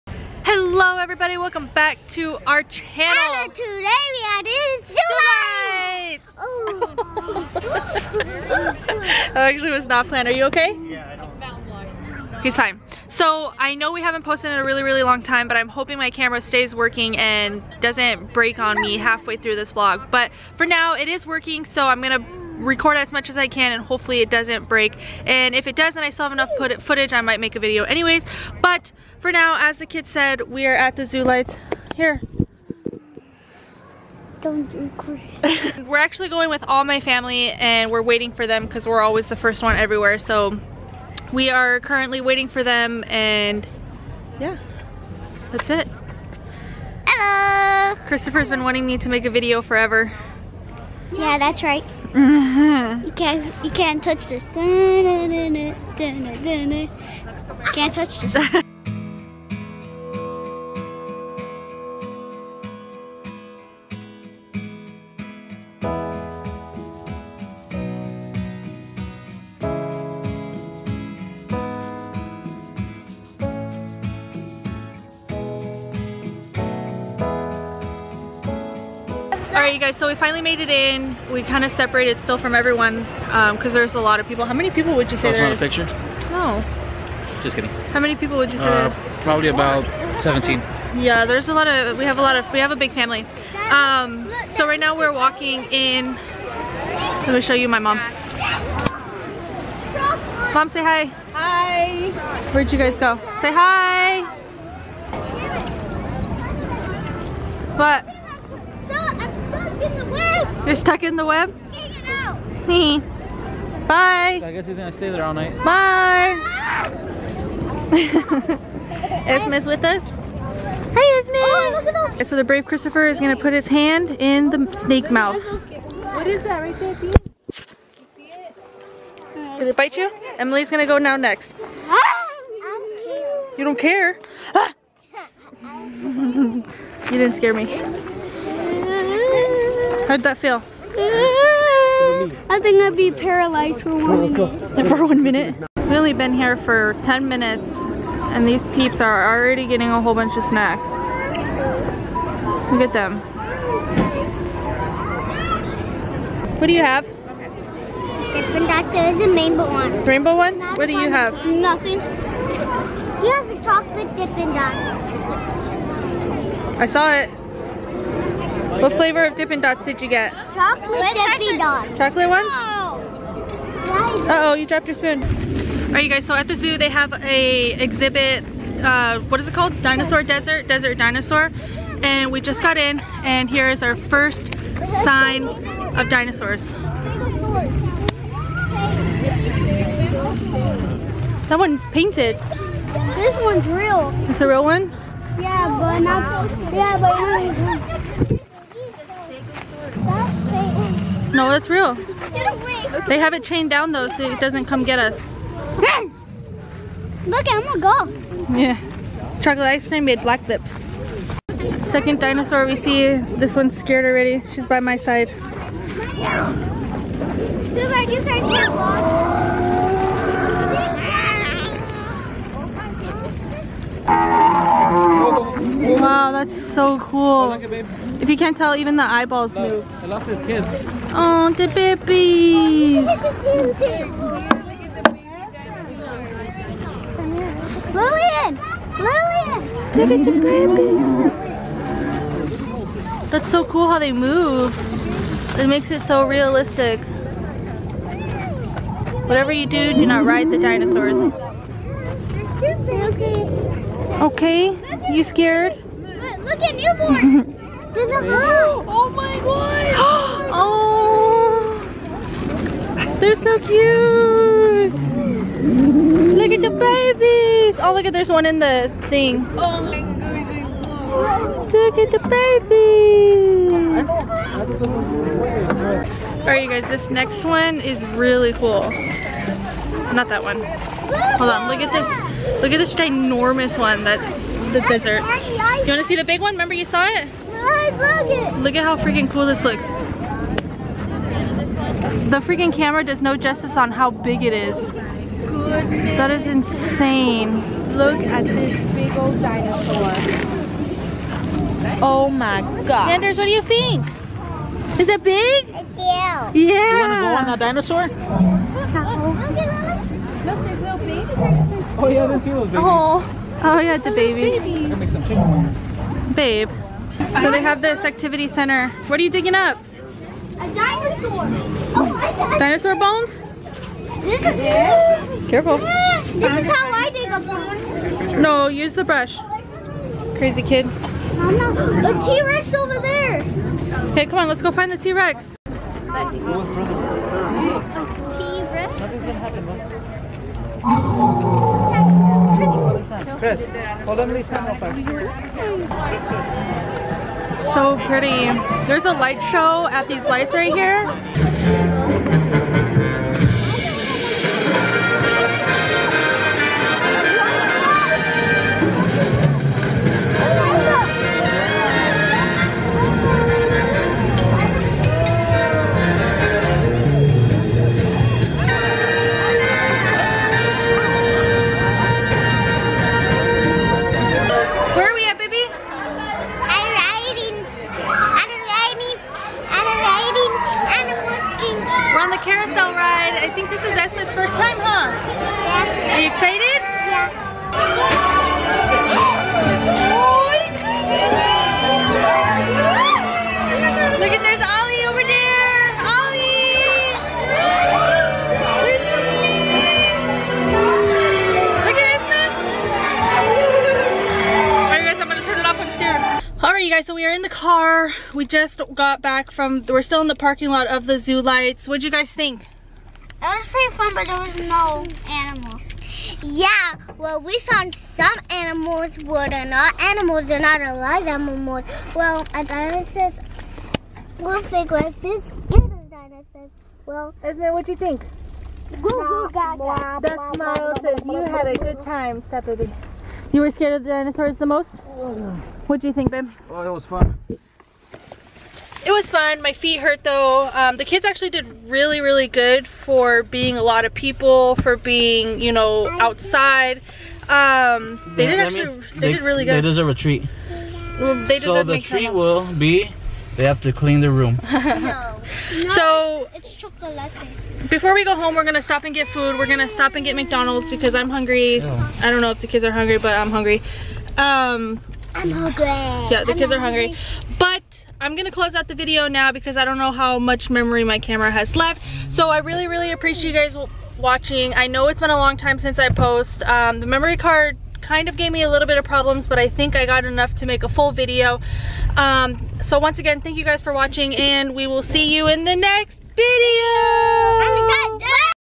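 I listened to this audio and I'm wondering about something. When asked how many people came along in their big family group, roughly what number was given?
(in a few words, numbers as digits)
17.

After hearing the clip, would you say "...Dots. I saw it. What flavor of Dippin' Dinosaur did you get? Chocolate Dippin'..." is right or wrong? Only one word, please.
wrong.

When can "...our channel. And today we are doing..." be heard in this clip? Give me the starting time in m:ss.
0:02.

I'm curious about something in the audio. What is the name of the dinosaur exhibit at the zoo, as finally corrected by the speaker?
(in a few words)
Desert Dinosaur.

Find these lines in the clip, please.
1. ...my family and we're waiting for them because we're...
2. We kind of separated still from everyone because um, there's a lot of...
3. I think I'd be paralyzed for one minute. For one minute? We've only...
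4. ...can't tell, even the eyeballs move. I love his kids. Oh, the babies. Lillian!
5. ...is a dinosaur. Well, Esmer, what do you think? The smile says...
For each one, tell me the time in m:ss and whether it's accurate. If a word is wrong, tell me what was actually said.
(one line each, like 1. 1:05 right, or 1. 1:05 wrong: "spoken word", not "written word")
1. 0:36 right
2. 1:21 right
3. 2:20 right
4. 3:48 right
5. 7:05 right.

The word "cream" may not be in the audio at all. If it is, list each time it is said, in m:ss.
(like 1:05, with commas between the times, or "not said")
3:29.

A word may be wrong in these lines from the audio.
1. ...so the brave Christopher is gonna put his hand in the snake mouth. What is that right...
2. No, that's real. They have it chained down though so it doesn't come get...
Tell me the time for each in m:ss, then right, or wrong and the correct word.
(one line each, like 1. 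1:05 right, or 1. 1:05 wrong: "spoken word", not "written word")
1. 2:02 right
2. 3:21 right.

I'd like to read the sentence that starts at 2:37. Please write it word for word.
Dippin' Dots is a rainbow one.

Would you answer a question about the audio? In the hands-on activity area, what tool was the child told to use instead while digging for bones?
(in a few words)
The brush.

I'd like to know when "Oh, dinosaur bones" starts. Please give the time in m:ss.
5:21.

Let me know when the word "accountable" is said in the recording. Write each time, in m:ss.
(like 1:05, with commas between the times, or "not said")
not said.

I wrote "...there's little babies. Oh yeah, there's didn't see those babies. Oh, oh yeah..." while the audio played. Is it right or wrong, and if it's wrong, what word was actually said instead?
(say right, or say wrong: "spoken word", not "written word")
right.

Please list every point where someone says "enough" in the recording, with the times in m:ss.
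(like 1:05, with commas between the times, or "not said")
0:26, 8:00.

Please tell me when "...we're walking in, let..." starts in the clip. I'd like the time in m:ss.
1:34.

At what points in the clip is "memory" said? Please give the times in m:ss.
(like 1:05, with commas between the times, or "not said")
7:50, 7:57.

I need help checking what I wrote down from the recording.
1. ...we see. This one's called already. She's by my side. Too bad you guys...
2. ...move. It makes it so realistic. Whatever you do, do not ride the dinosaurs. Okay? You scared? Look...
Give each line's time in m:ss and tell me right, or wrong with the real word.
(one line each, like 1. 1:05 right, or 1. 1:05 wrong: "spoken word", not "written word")
1. 3:32 wrong: "scared", not "called"
2. 4:04 right.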